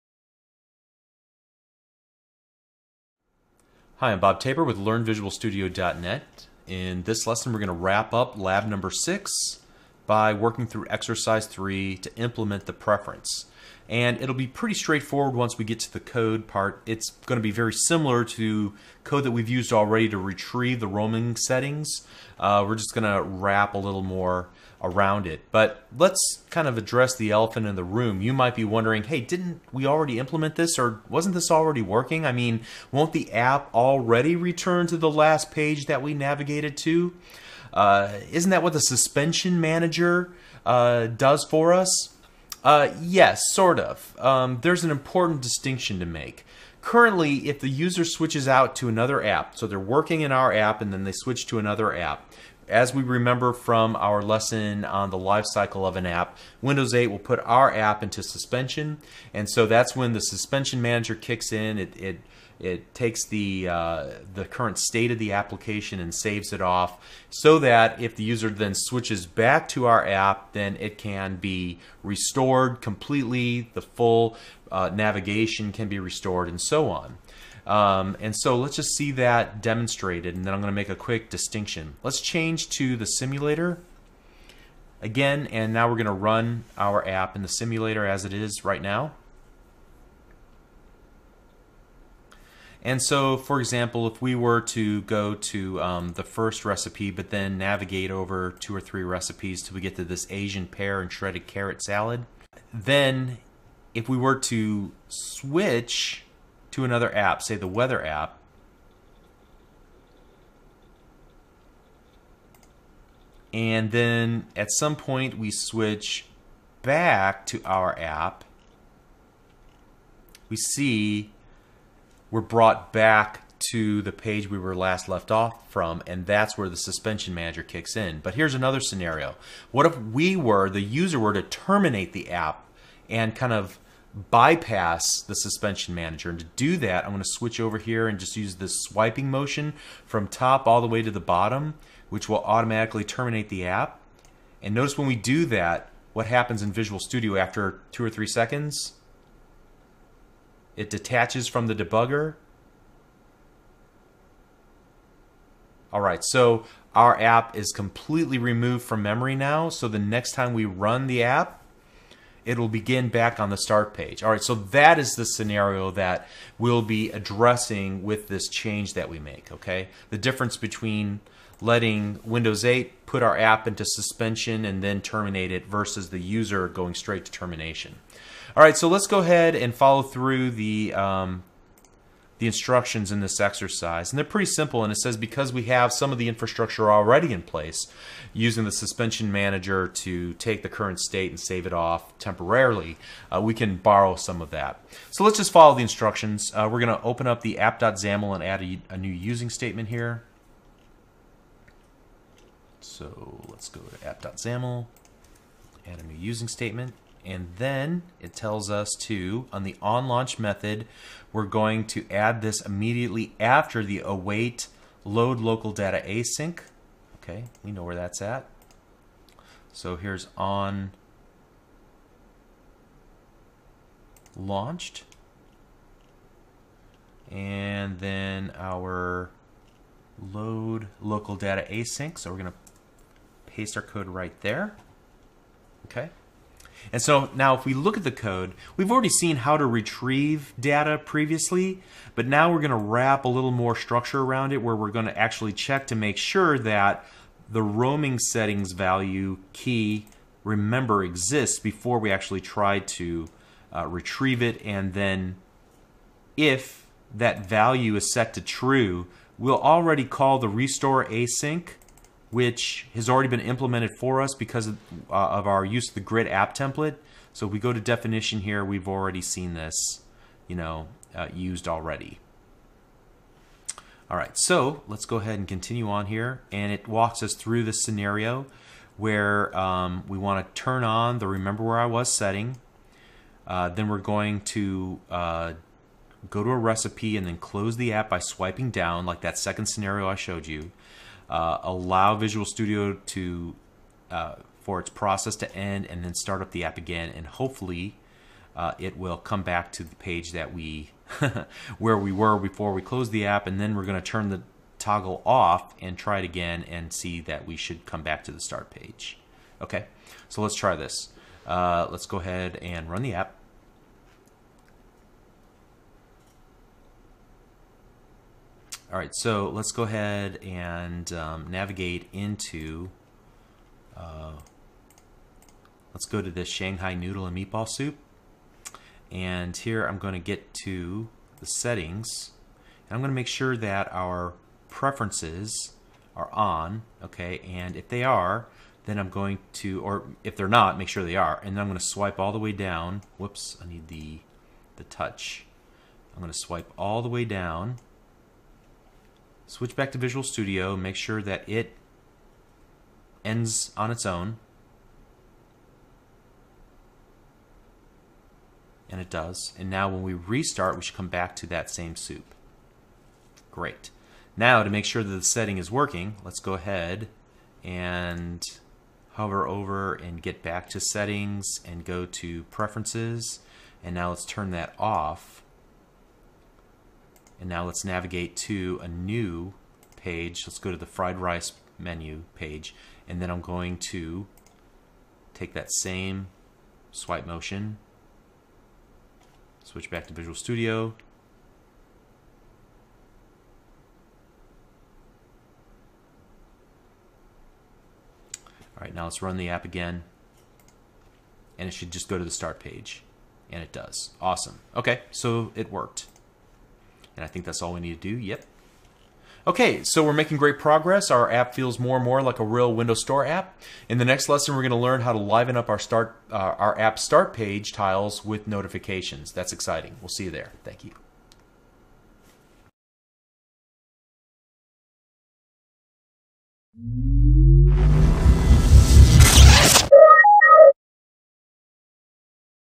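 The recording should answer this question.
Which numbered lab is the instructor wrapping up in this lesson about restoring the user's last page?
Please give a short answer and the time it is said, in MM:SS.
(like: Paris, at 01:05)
6, at 00:08.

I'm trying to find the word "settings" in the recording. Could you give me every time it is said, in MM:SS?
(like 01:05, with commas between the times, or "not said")
00:21, 04:08, 04:42, 05:31, 06:05, 06:10.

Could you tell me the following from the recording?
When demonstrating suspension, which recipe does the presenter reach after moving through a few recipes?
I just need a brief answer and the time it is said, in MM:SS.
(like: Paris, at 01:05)
Asian pear and shredded carrot salad, at 01:40.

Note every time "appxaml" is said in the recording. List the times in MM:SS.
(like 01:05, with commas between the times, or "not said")
03:17, 03:24.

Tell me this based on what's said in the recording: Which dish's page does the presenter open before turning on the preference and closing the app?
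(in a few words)
Shanghai Noodle and Meatball Soup.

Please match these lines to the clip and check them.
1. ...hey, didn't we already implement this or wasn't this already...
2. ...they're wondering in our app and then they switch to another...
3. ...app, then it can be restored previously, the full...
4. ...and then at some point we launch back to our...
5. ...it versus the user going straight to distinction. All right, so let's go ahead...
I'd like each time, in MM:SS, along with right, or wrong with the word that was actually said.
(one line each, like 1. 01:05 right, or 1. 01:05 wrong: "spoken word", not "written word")
1. 00:29 right
2. 00:49 wrong: "working", not "wondering"
3. 01:10 wrong: "completely", not "previously"
4. 01:53 wrong: "switch", not "launch"
5. 02:55 wrong: "termination", not "distinction".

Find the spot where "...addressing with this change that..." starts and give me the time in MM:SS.
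02:47.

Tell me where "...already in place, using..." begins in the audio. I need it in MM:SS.
03:06.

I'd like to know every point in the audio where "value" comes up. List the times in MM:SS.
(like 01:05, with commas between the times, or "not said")
04:08, 04:17.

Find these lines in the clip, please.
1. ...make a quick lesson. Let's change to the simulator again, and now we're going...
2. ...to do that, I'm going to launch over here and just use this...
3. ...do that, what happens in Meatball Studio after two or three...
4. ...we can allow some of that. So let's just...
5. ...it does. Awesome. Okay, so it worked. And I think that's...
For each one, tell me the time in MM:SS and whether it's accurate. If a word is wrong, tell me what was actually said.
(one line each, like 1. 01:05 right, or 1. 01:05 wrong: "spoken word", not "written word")
1. 01:20 wrong: "distinction", not "lesson"
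2. 02:16 wrong: "switch", not "launch"
3. 02:25 wrong: "Visual", not "Meatball"
4. 03:13 wrong: "borrow", not "allow"
5. 06:43 right.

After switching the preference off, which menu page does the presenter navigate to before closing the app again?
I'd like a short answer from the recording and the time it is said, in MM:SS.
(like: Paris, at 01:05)
Fried rice, at 06:20.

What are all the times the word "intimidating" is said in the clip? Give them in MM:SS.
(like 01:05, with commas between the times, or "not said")
not said.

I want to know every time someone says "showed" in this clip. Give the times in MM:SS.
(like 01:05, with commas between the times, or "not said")
04:50.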